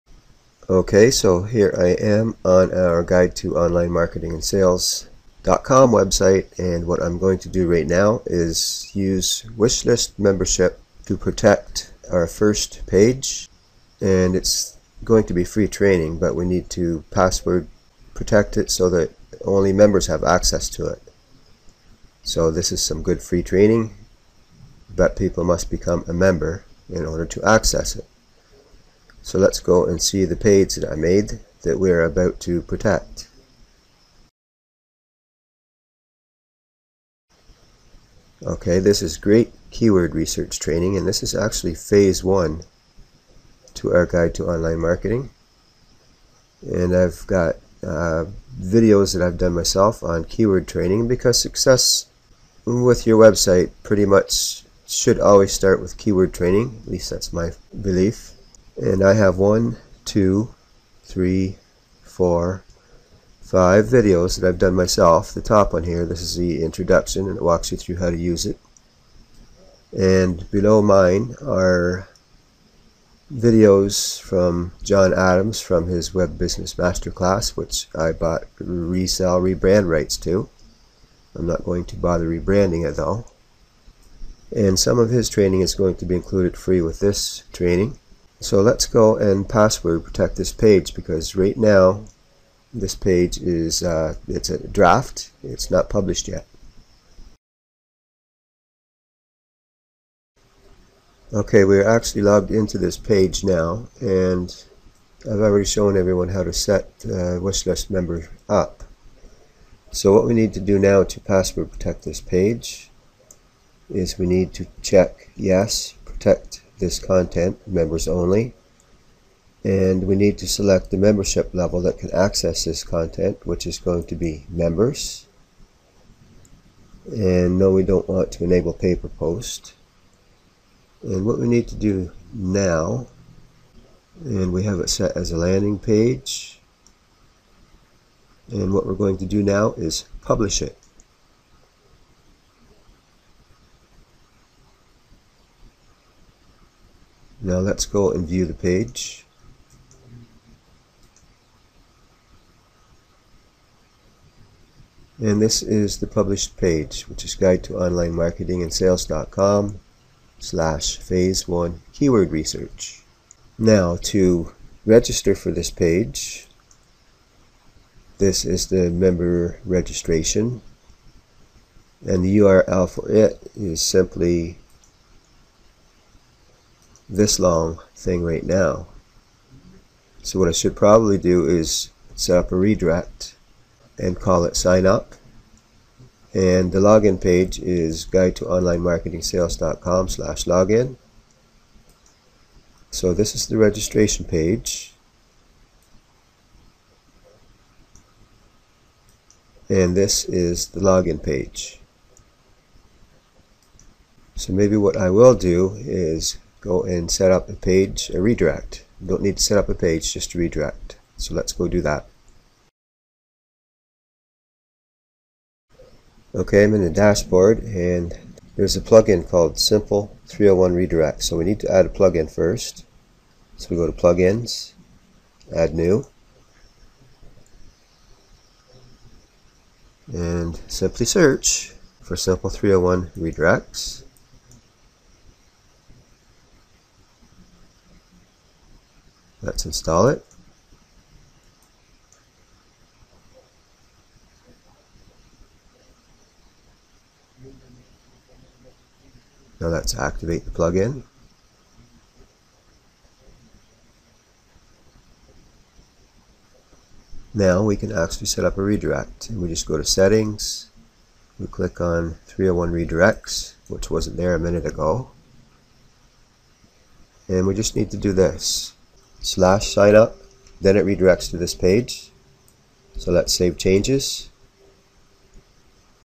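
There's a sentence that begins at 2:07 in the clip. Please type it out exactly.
And no, we don't want to enable pay per post.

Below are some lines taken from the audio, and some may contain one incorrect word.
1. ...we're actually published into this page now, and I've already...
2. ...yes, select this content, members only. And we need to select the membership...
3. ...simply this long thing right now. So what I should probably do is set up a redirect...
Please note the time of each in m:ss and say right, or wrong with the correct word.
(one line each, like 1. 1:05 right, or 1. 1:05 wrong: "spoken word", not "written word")
1. 1:41 wrong: "logged", not "published"
2. 1:55 wrong: "protect", not "select"
3. 2:53 right.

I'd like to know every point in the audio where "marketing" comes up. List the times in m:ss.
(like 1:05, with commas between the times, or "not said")
0:03, 0:44, 2:38, 3:08.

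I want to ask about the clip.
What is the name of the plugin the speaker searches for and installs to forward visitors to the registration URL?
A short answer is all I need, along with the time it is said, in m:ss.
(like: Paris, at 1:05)
Simple 301 Redirects, at 3:52.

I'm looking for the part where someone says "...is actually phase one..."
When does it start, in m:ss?
0:41.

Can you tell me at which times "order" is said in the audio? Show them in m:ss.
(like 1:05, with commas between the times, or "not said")
0:27.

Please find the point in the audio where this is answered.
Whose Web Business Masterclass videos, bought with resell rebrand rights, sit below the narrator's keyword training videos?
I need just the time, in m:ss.
1:14.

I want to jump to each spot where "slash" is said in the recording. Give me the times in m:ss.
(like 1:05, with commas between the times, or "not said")
2:40, 3:10, 4:29.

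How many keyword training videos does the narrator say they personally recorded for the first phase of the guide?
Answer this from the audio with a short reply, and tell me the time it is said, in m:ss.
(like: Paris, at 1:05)
5, at 1:03.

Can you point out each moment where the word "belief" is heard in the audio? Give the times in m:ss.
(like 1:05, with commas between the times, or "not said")
0:57.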